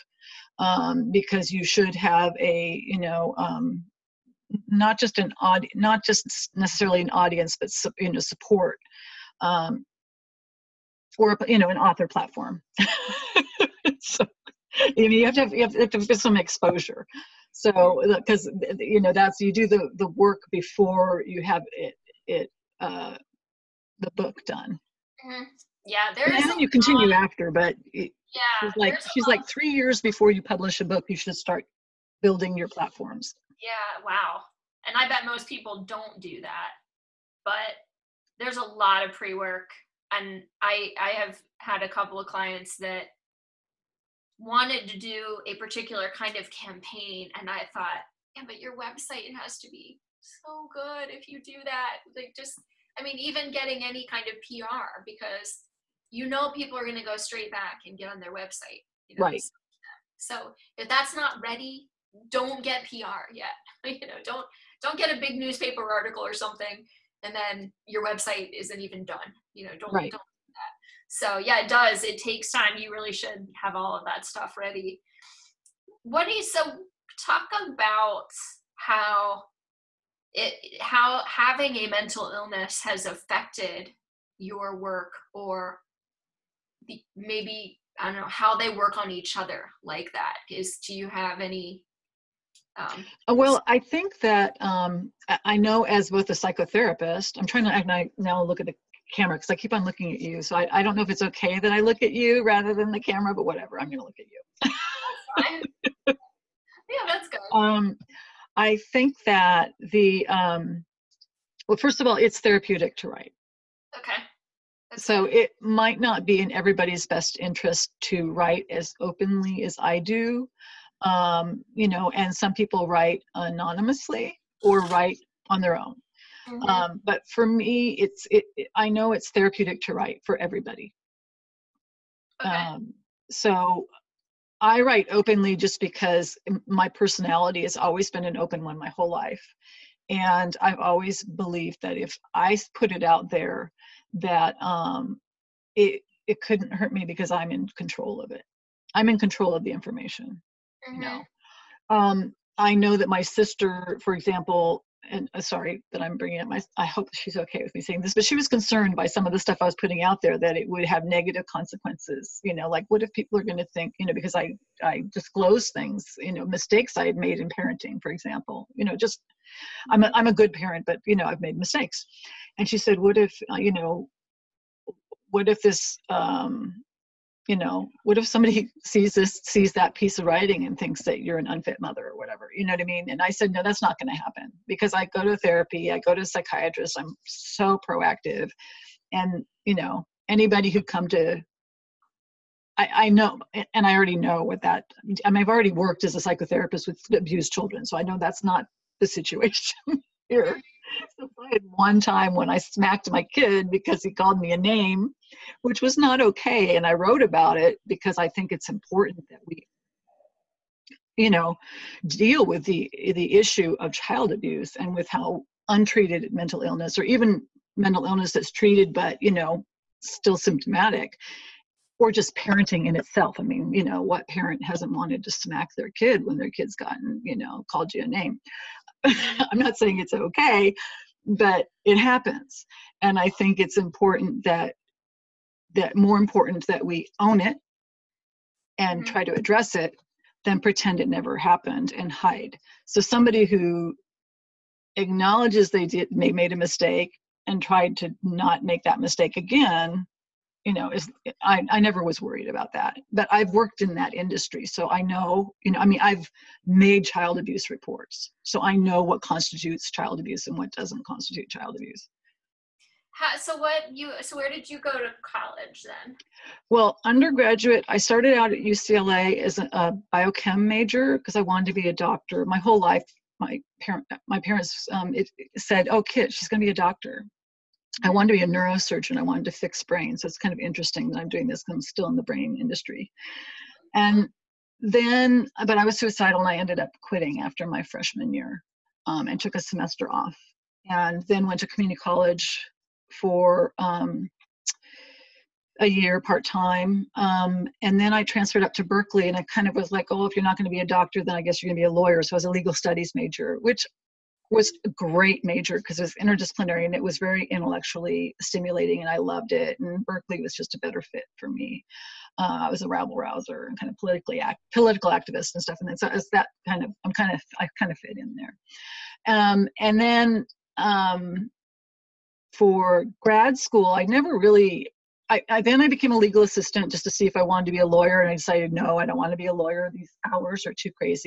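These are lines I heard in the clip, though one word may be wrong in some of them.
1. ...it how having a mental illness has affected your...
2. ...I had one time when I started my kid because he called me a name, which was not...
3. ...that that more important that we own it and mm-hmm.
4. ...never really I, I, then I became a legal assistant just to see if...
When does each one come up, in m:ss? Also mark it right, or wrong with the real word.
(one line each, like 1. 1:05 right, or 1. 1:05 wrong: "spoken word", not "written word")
1. 1:20 right
2. 3:21 wrong: "smacked", not "started"
3. 3:54 right
4. 5:24 right.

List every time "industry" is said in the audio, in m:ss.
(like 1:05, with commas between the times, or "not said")
4:14, 4:42.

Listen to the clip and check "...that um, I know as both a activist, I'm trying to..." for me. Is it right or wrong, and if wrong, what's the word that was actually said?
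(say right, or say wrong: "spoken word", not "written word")
wrong: "psychotherapist", not "activist".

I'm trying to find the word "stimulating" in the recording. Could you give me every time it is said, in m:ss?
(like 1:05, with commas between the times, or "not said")
5:08.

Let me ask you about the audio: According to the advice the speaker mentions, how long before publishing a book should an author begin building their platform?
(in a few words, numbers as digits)
3 years.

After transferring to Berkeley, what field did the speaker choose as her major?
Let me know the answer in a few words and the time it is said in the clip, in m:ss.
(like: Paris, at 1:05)
Legal studies, at 5:02.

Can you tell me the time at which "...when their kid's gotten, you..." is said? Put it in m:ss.
3:46.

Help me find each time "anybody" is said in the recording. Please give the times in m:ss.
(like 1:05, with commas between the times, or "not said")
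3:10.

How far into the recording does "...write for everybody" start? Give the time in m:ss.
2:09.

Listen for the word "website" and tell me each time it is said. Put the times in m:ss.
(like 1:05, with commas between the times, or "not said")
0:48, 0:58, 1:08.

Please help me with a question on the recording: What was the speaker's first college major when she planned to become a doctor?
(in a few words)
Biochem.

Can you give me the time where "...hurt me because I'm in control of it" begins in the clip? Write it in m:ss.
2:26.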